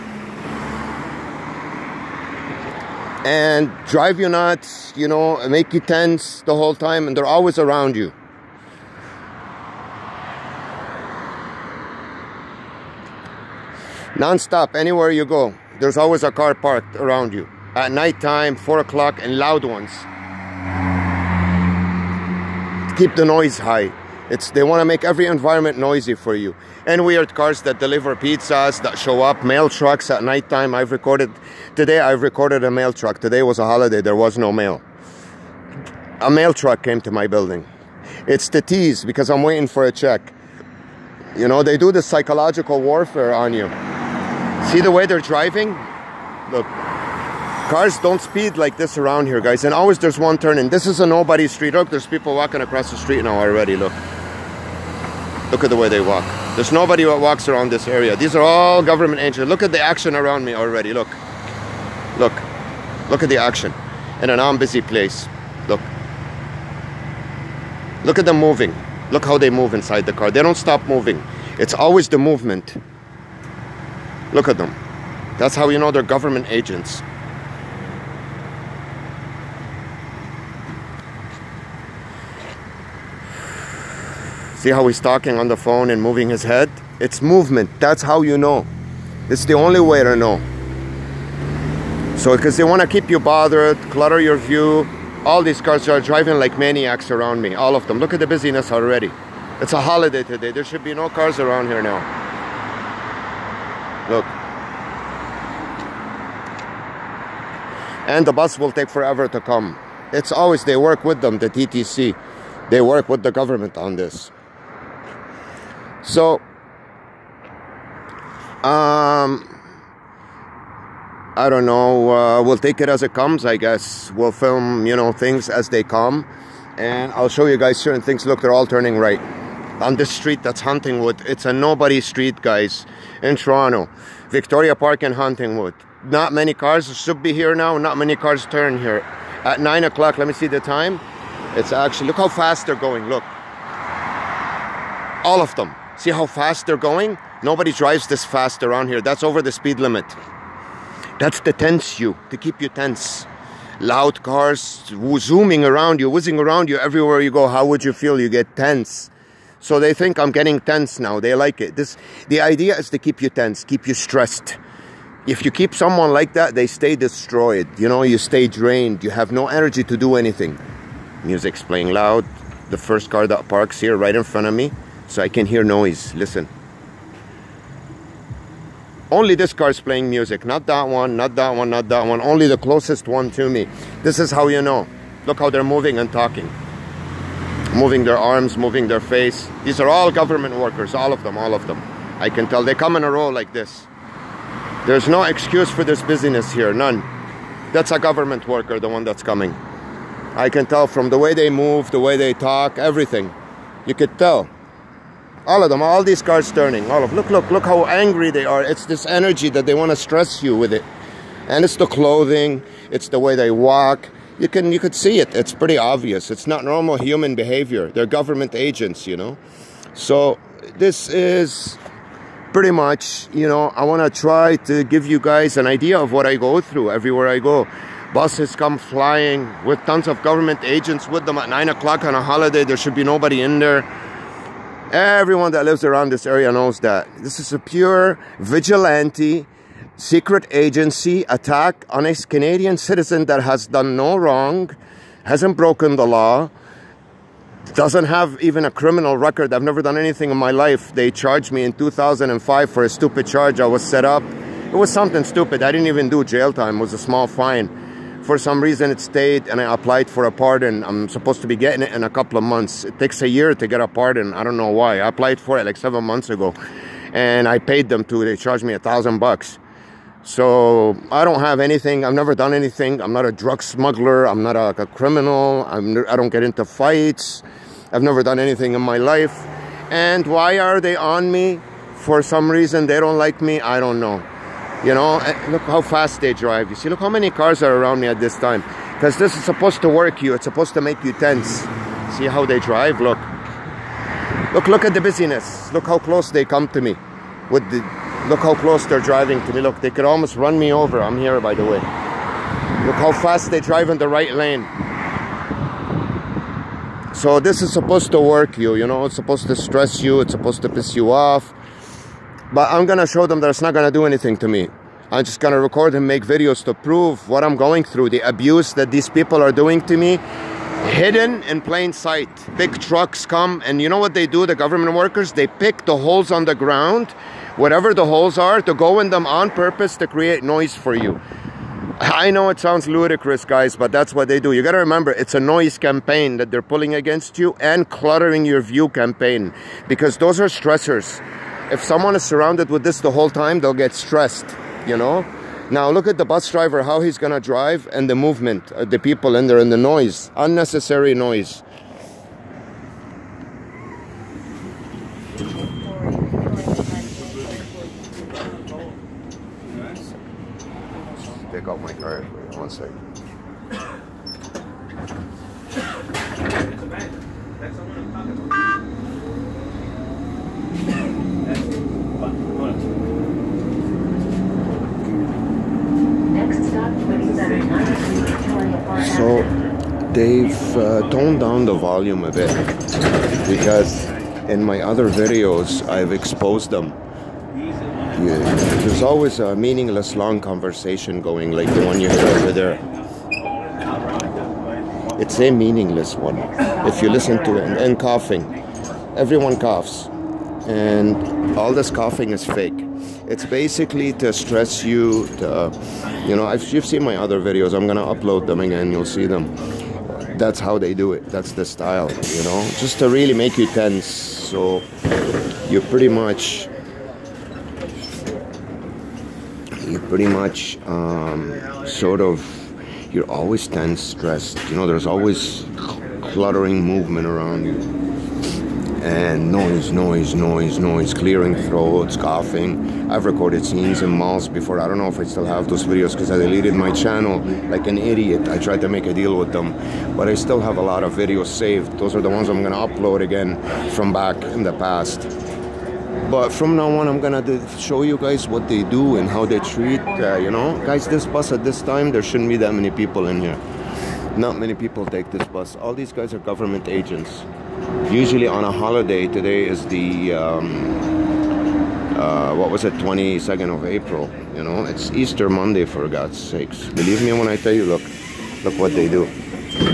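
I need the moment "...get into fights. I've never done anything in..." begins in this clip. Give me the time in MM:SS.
04:36.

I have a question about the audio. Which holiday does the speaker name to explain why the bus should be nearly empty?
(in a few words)
Easter Monday.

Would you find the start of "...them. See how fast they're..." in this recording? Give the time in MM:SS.
02:25.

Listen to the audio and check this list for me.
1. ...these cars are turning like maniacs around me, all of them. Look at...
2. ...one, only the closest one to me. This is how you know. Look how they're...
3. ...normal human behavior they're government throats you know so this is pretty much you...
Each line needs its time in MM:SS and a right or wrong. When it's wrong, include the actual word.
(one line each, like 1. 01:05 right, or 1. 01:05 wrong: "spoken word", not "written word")
1. 01:35 wrong: "driving", not "turning"
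2. 03:02 right
3. 03:36 wrong: "agents", not "throats".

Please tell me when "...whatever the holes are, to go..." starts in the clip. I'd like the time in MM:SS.
05:27.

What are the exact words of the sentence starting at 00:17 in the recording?
At nighttime, 4 o'clock, and loud ones.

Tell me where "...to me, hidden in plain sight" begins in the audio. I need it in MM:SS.
05:19.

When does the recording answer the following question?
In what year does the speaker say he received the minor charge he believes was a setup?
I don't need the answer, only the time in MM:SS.
04:11.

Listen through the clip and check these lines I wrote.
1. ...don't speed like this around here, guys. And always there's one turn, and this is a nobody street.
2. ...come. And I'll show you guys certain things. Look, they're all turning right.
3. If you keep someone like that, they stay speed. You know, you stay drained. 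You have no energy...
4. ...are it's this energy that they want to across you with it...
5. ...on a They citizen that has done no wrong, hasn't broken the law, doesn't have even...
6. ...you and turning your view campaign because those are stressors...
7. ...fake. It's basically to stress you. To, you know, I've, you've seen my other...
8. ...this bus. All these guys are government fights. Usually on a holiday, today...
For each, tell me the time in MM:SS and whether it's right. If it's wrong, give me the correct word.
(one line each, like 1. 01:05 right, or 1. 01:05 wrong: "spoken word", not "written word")
1. 00:47 right
2. 02:05 right
3. 02:45 wrong: "destroyed", not "speed"
4. 03:28 wrong: "stress", not "across"
5. 04:01 wrong: "Canadian", not "They"
6. 05:37 wrong: "cluttering", not "turning"
7. 06:42 right
8. 07:35 wrong: "agents", not "fights".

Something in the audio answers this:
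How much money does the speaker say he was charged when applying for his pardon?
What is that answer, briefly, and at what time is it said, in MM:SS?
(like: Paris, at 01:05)
$1,000, at 04:28.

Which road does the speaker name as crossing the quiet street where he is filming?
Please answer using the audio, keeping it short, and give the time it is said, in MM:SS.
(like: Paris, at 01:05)
Victoria Park, at 02:14.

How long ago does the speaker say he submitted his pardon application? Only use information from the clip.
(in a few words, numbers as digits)
7 months ago.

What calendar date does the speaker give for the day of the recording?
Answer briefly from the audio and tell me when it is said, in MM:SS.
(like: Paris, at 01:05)
22nd of April, at 07:42.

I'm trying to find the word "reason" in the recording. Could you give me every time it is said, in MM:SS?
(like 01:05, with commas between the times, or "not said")
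04:18, 04:42.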